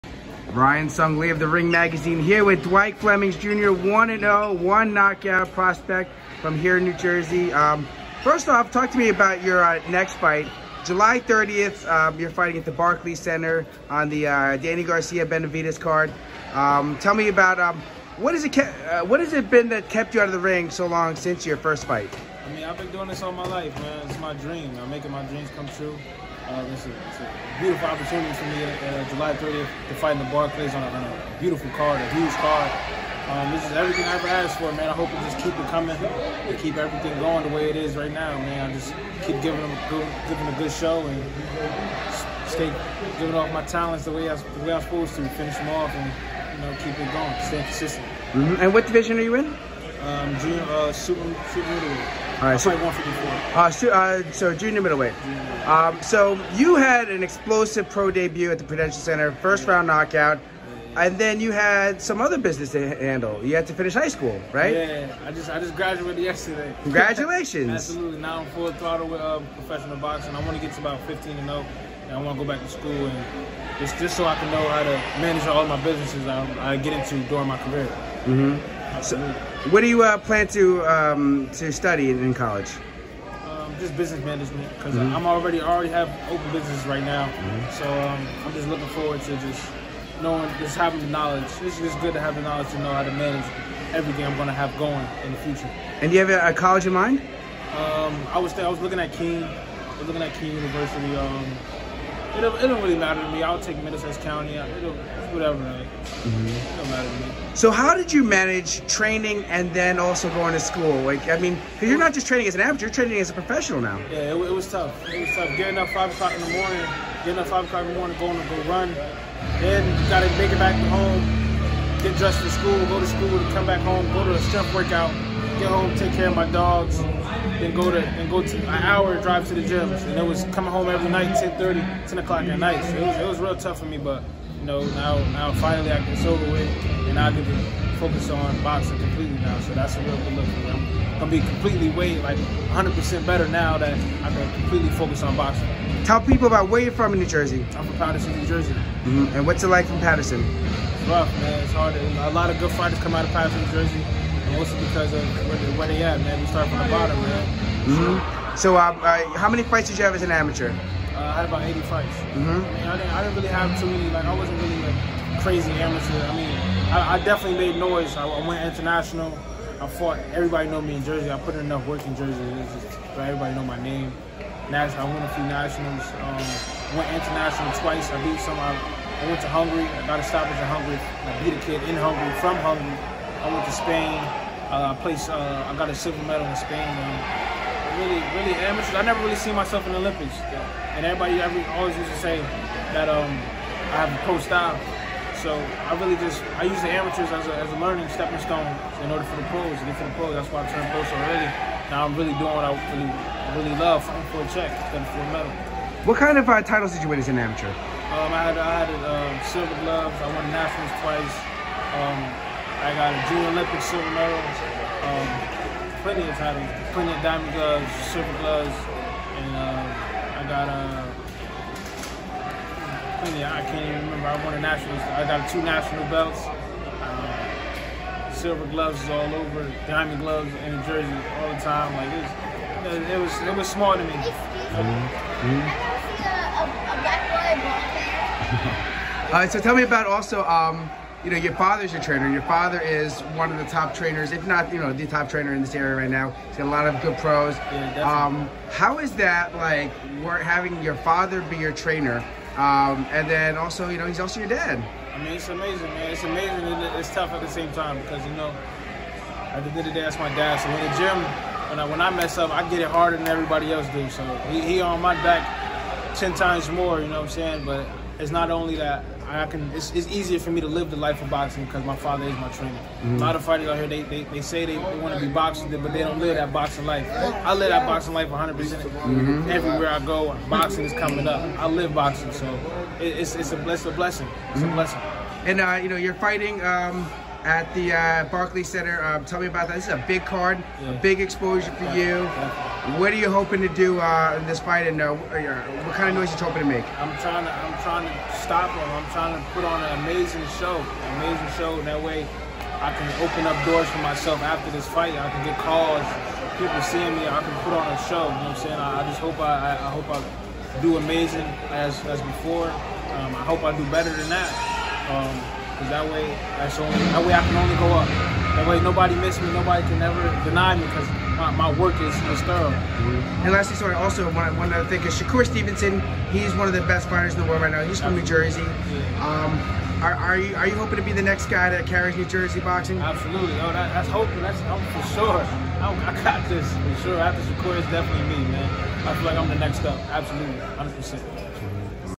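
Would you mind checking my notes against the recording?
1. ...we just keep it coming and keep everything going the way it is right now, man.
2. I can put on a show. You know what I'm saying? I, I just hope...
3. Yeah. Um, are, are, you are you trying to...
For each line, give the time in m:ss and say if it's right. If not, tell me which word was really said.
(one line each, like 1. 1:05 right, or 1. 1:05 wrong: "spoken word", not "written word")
1. 0:35 right
2. 5:07 right
3. 5:28 wrong: "hoping", not "trying".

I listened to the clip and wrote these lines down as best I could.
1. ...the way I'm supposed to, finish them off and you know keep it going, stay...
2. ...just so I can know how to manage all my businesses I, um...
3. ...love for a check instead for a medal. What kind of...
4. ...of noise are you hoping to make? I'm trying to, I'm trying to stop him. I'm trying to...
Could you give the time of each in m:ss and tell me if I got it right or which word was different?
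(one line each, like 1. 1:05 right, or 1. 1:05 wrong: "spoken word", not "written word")
1. 0:44 right
2. 1:13 right
3. 3:23 right
4. 4:56 right.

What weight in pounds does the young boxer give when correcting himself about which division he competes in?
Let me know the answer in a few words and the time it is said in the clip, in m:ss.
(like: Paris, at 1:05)
154, at 0:52.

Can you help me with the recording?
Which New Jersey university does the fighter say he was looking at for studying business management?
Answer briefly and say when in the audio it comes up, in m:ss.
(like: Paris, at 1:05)
Kean University, at 1:40.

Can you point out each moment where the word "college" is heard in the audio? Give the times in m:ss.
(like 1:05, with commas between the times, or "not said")
1:22, 1:36.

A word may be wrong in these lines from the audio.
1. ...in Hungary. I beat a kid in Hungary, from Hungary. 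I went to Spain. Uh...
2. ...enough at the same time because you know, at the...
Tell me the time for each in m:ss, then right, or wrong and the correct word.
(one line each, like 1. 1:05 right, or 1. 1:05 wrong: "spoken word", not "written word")
1. 3:00 right
2. 4:17 wrong: "tough", not "enough".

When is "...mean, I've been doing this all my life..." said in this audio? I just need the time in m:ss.
0:22.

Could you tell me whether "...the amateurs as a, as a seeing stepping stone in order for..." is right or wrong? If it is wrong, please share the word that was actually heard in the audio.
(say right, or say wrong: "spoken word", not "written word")
wrong: "learning", not "seeing".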